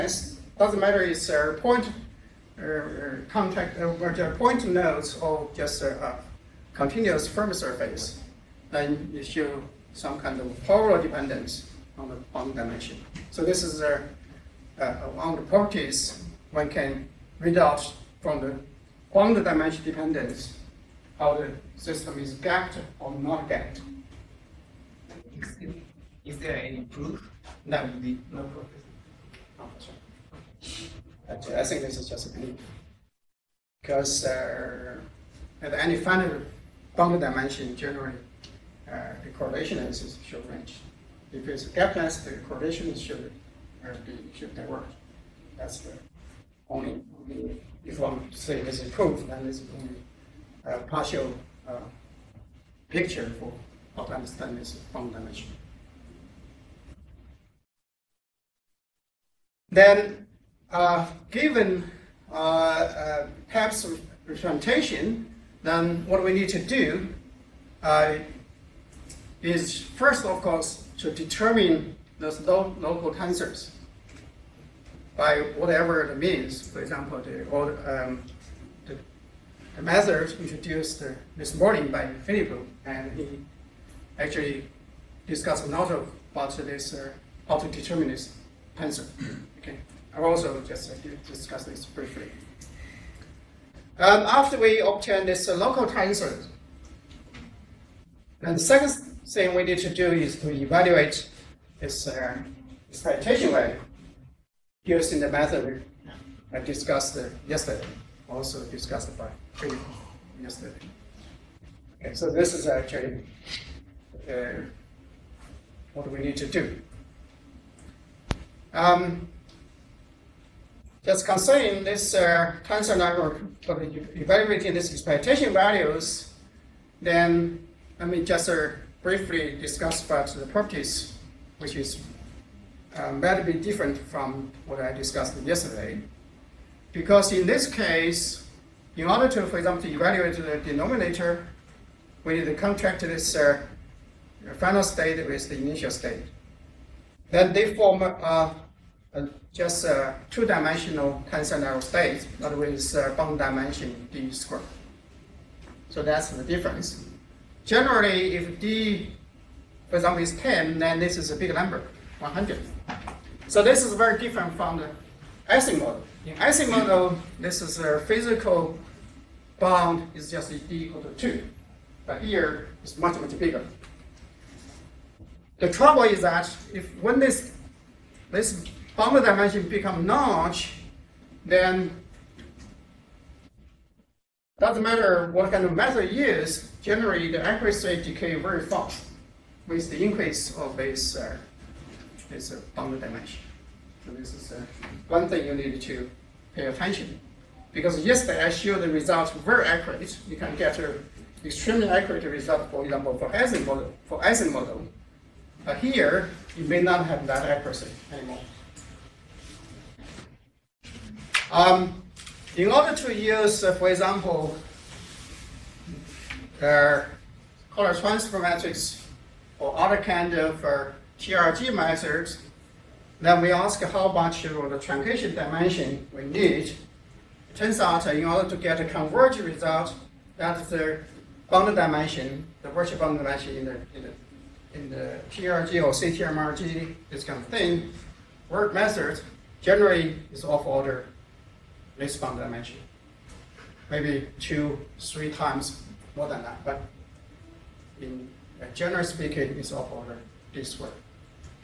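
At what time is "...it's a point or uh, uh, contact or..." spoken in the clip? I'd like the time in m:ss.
0:01.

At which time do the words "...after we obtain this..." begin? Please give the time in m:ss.
1:34.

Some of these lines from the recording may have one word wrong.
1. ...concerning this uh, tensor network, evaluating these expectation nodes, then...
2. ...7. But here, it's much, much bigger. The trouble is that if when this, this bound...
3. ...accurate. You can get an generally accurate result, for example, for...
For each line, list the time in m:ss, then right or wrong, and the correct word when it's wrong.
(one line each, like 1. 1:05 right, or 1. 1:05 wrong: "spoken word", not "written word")
1. 2:01 wrong: "values", not "nodes"
2. 2:51 wrong: "2", not "7"
3. 3:19 wrong: "extremely", not "generally".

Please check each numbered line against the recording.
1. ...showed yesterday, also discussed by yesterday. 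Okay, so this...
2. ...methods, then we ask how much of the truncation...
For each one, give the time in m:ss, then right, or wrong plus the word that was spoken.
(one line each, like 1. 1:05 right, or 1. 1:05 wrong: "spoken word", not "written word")
1. 1:46 wrong: "discussed", not "showed"
2. 3:41 right.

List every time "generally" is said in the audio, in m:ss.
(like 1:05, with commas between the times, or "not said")
0:37, 2:37, 3:06, 3:59, 4:08.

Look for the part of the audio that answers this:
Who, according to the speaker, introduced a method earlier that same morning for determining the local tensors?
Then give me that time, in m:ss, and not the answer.
1:22.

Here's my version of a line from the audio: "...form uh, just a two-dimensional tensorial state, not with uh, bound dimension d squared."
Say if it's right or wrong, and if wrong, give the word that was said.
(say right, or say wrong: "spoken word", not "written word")
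right.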